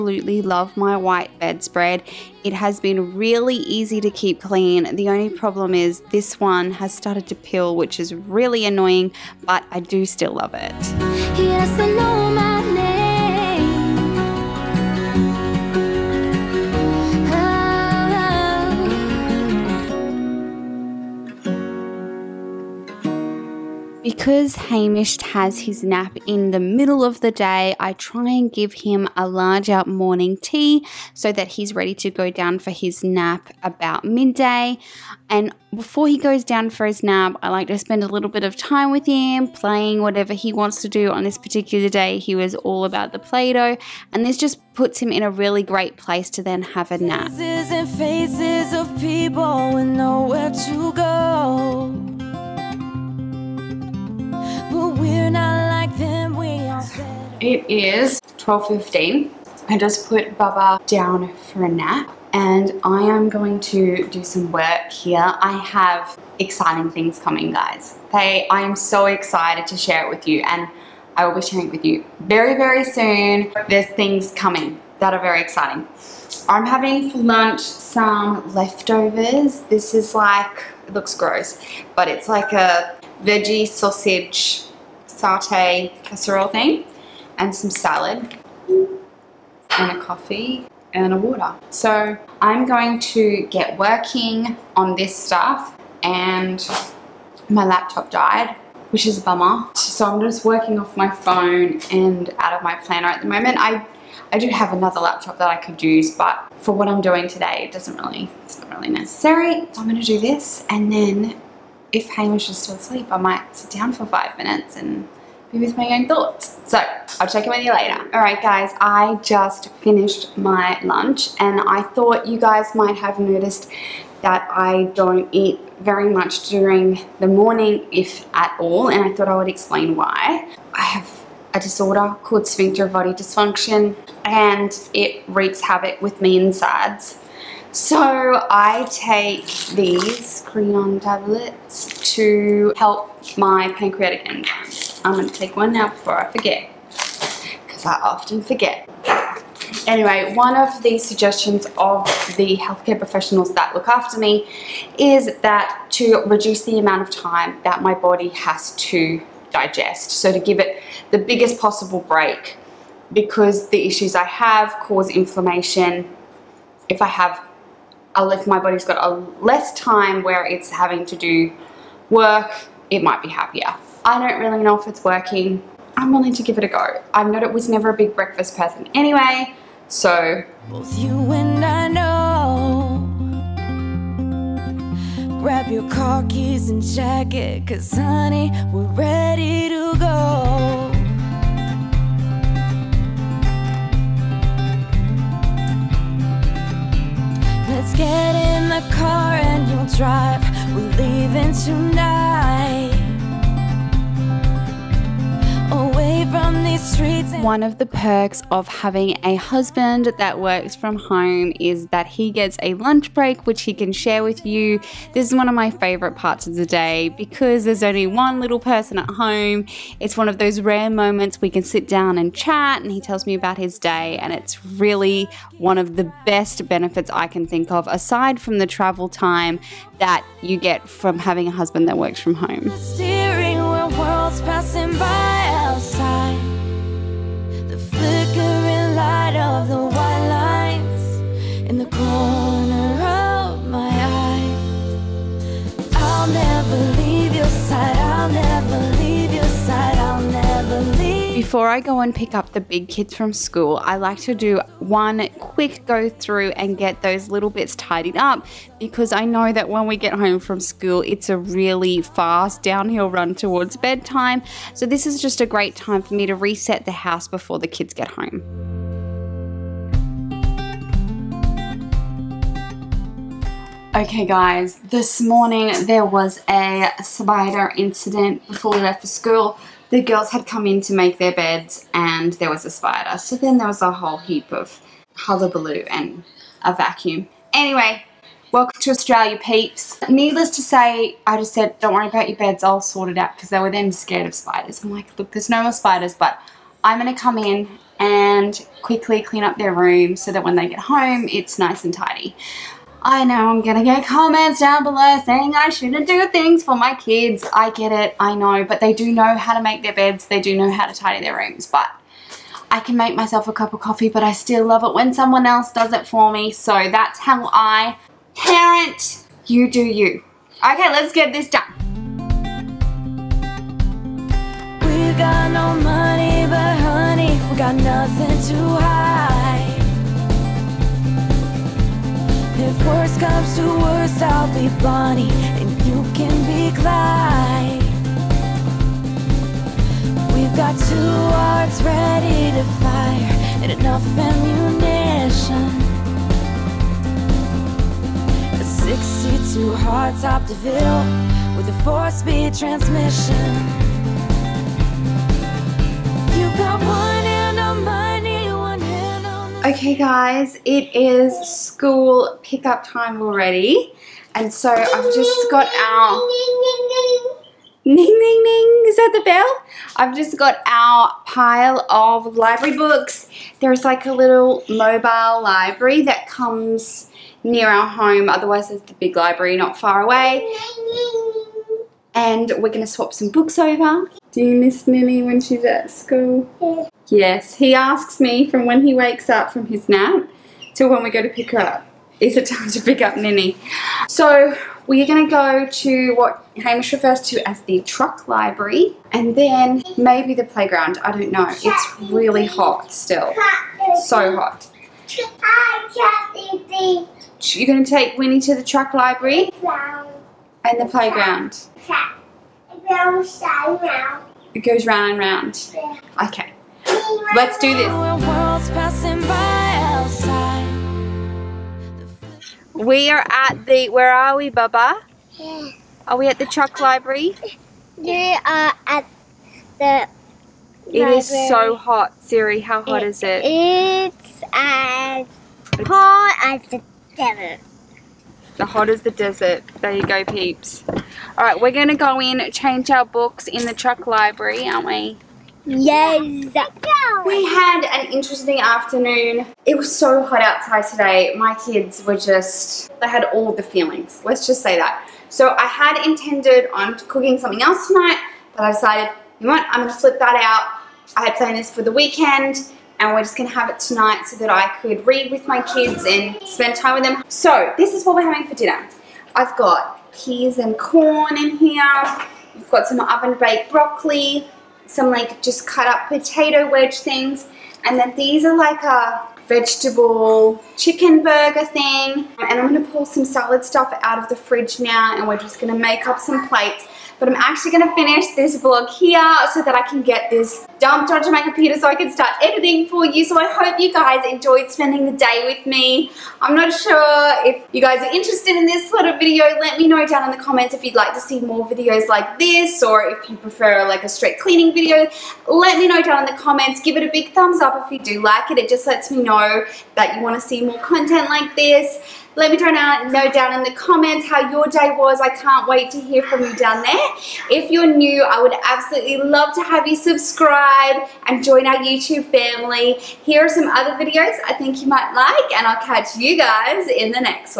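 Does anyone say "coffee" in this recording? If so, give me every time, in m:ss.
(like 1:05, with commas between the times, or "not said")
1:29, 5:13.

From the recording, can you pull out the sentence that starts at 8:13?
So I hope you guys enjoyed spending the day with me.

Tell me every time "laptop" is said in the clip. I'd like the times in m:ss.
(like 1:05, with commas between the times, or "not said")
1:37, 1:44.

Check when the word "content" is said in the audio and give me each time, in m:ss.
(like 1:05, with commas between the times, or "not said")
8:30.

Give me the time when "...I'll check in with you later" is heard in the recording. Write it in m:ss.
1:57.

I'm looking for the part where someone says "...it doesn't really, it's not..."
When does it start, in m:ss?
1:47.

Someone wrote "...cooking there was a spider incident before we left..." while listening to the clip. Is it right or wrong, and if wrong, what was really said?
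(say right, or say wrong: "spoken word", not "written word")
wrong: "morning", not "cooking".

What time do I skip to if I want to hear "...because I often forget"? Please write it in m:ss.
2:27.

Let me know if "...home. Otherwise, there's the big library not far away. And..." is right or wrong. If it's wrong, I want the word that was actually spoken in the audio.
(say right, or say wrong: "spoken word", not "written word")
right.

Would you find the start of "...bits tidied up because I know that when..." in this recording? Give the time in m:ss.
4:17.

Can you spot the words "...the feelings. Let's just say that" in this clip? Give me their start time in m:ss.
7:33.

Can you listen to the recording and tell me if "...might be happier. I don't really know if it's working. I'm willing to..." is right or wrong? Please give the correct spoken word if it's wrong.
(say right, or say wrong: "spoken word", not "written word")
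right.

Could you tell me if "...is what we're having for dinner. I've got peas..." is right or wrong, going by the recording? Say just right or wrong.
right.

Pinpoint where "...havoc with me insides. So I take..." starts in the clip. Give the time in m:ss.
2:15.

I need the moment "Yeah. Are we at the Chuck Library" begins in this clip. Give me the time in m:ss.
7:05.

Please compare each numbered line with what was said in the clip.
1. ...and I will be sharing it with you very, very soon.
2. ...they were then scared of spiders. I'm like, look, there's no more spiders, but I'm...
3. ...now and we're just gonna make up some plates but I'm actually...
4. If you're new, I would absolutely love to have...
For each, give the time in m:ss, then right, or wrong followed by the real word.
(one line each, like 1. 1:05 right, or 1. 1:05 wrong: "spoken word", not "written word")
1. 1:10 right
2. 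4:53 right
3. 8:04 right
4. 8:37 right.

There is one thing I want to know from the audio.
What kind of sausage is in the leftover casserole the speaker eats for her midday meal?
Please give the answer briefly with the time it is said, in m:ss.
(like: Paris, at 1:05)
Veggie sausage, at 1:23.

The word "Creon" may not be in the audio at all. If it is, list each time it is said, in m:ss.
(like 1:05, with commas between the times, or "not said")
2:20.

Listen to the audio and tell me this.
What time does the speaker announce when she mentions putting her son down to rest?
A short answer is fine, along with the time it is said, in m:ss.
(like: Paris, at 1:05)
12:15, at 0:58.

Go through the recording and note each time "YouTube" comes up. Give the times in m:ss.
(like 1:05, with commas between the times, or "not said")
8:41.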